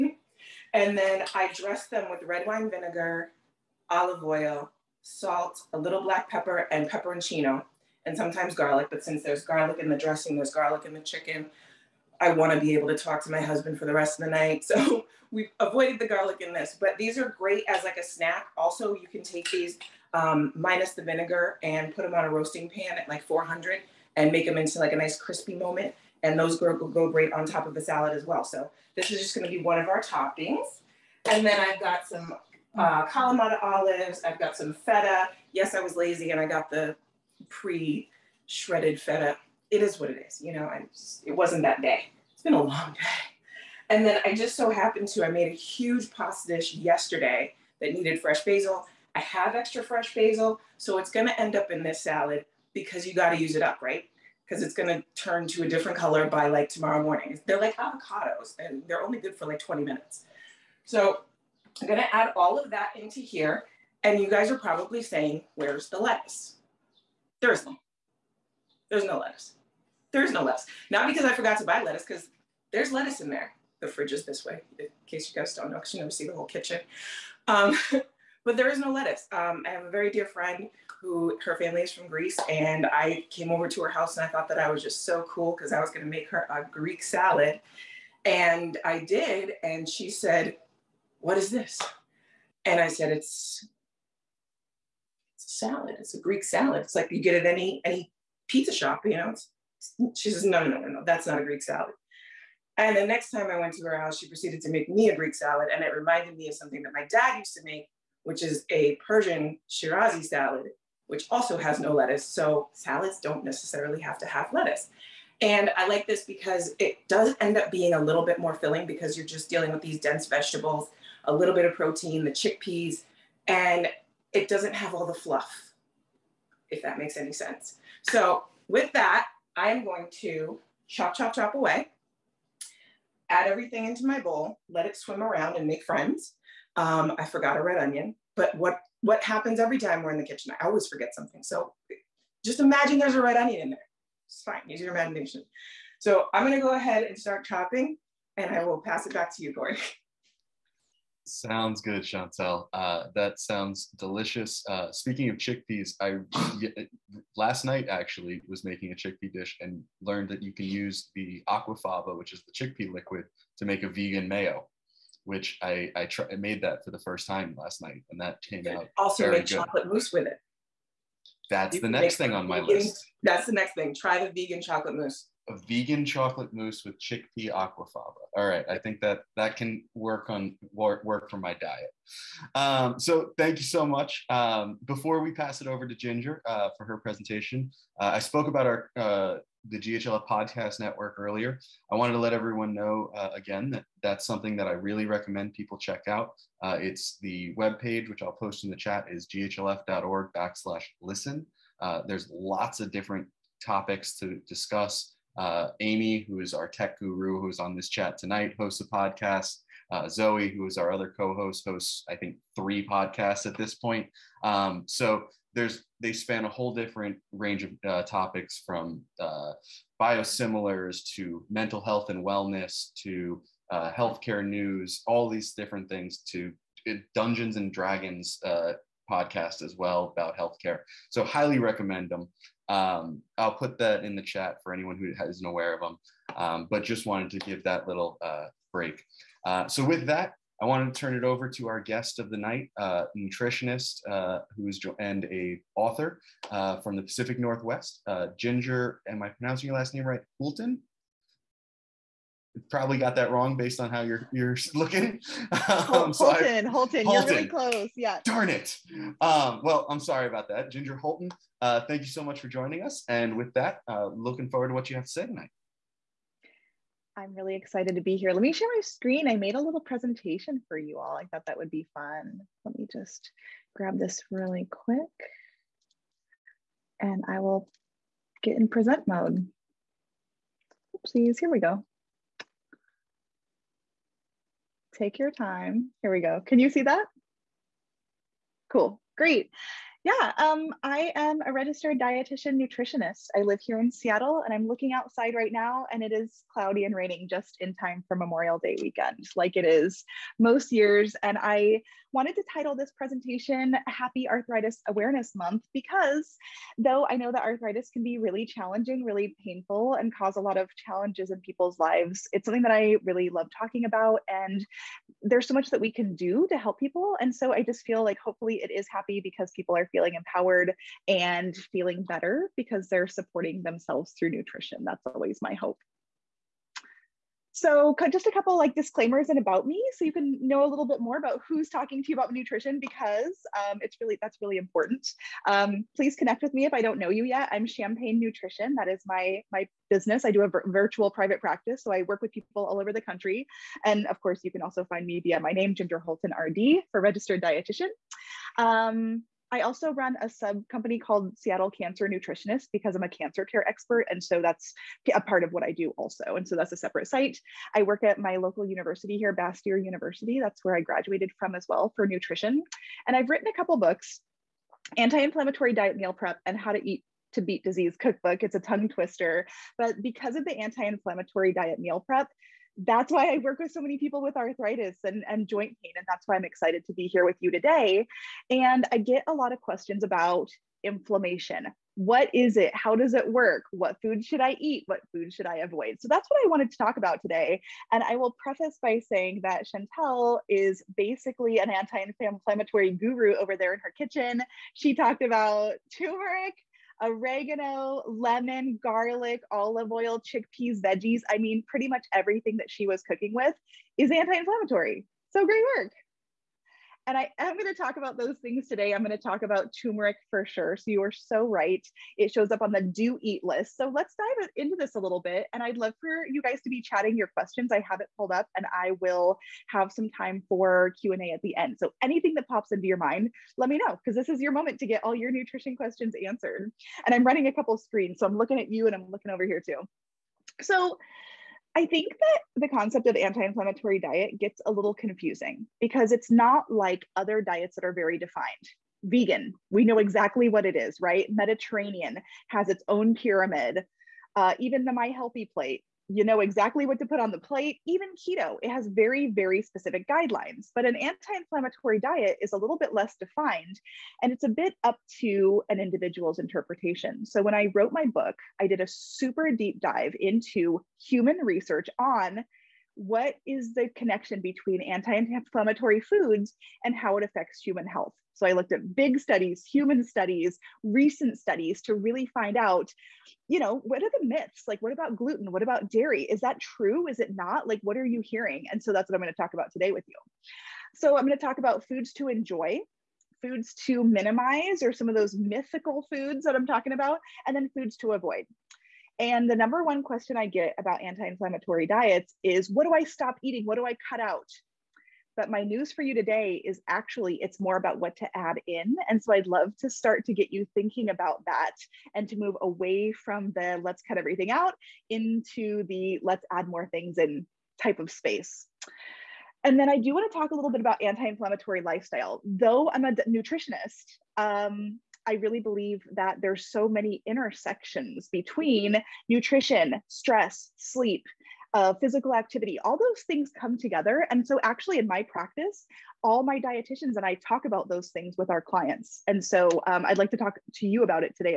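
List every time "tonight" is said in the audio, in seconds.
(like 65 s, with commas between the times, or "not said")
208 s, 265 s.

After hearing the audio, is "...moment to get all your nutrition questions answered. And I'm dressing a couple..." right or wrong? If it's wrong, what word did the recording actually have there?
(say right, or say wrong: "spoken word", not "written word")
wrong: "running", not "dressing".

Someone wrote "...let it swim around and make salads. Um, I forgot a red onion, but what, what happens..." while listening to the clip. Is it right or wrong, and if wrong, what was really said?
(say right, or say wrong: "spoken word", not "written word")
wrong: "friends", not "salads".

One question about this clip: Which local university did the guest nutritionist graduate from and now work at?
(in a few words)
Bastyr University.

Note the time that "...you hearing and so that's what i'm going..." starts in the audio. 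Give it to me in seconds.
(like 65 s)
478 s.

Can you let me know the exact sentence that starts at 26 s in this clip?
And those go, go great on top of the salad as well.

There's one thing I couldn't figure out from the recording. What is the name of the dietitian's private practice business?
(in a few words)
Champagne Nutrition.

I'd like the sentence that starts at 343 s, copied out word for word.
And of course, you can also find me via my name, Ginger Hultin RD, for registered dietitian.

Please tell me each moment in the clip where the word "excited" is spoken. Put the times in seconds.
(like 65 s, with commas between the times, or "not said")
267 s, 376 s.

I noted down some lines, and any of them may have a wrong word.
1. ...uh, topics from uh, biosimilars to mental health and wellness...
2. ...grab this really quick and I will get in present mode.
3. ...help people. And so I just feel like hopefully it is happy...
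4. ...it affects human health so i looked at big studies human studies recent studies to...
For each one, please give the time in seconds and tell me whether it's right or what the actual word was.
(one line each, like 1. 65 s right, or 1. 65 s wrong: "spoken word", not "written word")
1. 217 s right
2. 273 s right
3. 316 s right
4. 467 s right.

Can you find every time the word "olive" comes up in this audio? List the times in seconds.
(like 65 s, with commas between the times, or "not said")
3 s, 33 s, 399 s.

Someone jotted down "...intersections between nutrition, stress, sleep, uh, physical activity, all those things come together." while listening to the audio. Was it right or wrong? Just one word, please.
right.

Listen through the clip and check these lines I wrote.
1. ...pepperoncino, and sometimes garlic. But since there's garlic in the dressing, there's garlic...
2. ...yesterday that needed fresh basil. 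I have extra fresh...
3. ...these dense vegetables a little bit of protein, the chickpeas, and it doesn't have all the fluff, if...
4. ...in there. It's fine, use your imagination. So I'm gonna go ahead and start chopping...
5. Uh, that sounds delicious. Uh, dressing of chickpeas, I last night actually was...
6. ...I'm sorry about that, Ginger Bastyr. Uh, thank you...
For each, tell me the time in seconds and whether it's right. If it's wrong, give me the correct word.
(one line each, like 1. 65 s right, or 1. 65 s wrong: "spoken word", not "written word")
1. 6 s right
2. 46 s right
3. 119 s right
4. 143 s right
5. 152 s wrong: "speaking", not "dressing"
6. 259 s wrong: "Hultin", not "Bastyr".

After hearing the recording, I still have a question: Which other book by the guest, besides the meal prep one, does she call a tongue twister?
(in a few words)
How to Eat to Beat Disease Cookbook.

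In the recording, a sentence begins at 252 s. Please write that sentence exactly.
probably got that wrong based on how you're you're looking.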